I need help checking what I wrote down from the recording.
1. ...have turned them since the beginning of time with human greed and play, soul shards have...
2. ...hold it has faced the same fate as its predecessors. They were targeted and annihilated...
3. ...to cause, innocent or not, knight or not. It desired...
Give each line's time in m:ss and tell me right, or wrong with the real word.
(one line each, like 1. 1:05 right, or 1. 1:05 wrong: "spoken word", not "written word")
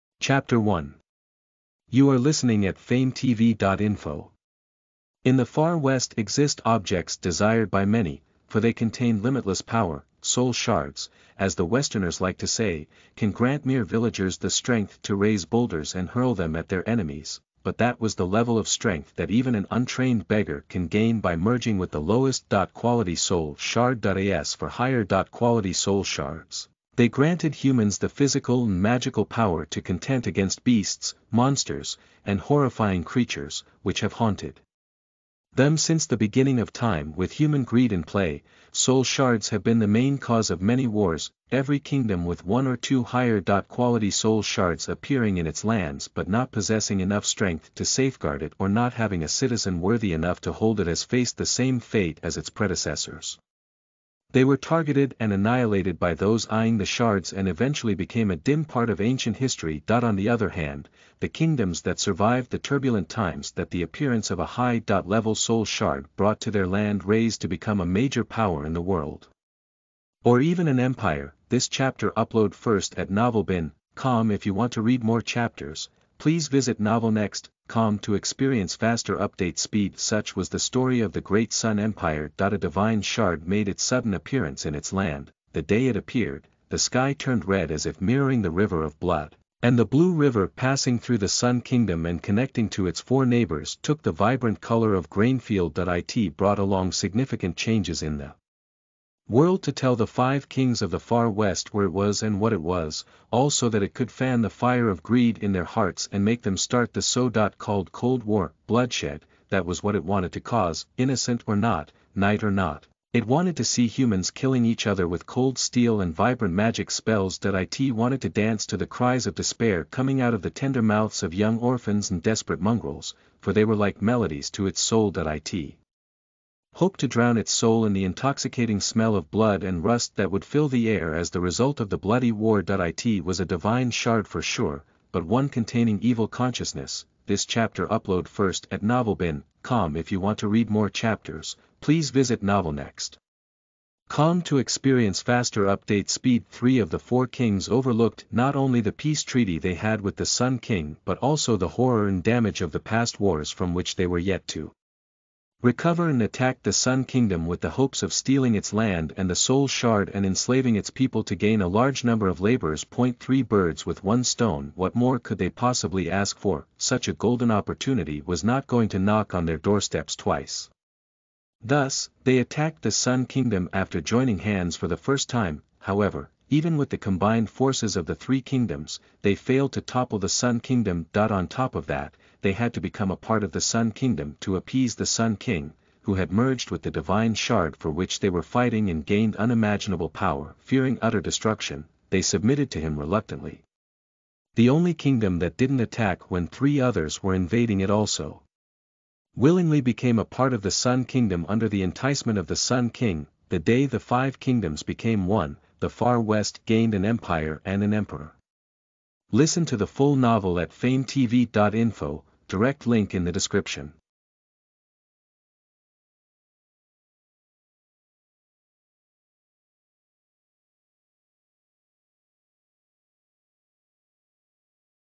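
1. 0:34 wrong: "haunted", not "turned"
2. 0:50 right
3. 1:50 wrong: "wanted", not "desired".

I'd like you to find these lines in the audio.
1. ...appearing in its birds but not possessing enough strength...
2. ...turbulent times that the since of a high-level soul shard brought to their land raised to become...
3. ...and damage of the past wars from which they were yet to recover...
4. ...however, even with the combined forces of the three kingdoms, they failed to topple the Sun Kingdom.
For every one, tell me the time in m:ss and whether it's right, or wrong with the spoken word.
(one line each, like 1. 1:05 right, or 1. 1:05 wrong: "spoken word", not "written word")
1. 0:44 wrong: "lands", not "birds"
2. 1:02 wrong: "appearance", not "since"
3. 2:32 right
4. 2:55 right.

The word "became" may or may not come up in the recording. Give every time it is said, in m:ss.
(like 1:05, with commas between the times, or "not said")
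0:57, 3:19, 3:24.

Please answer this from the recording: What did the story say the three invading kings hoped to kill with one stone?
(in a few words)
three birds.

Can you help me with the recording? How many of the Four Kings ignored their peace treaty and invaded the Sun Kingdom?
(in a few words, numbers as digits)
3.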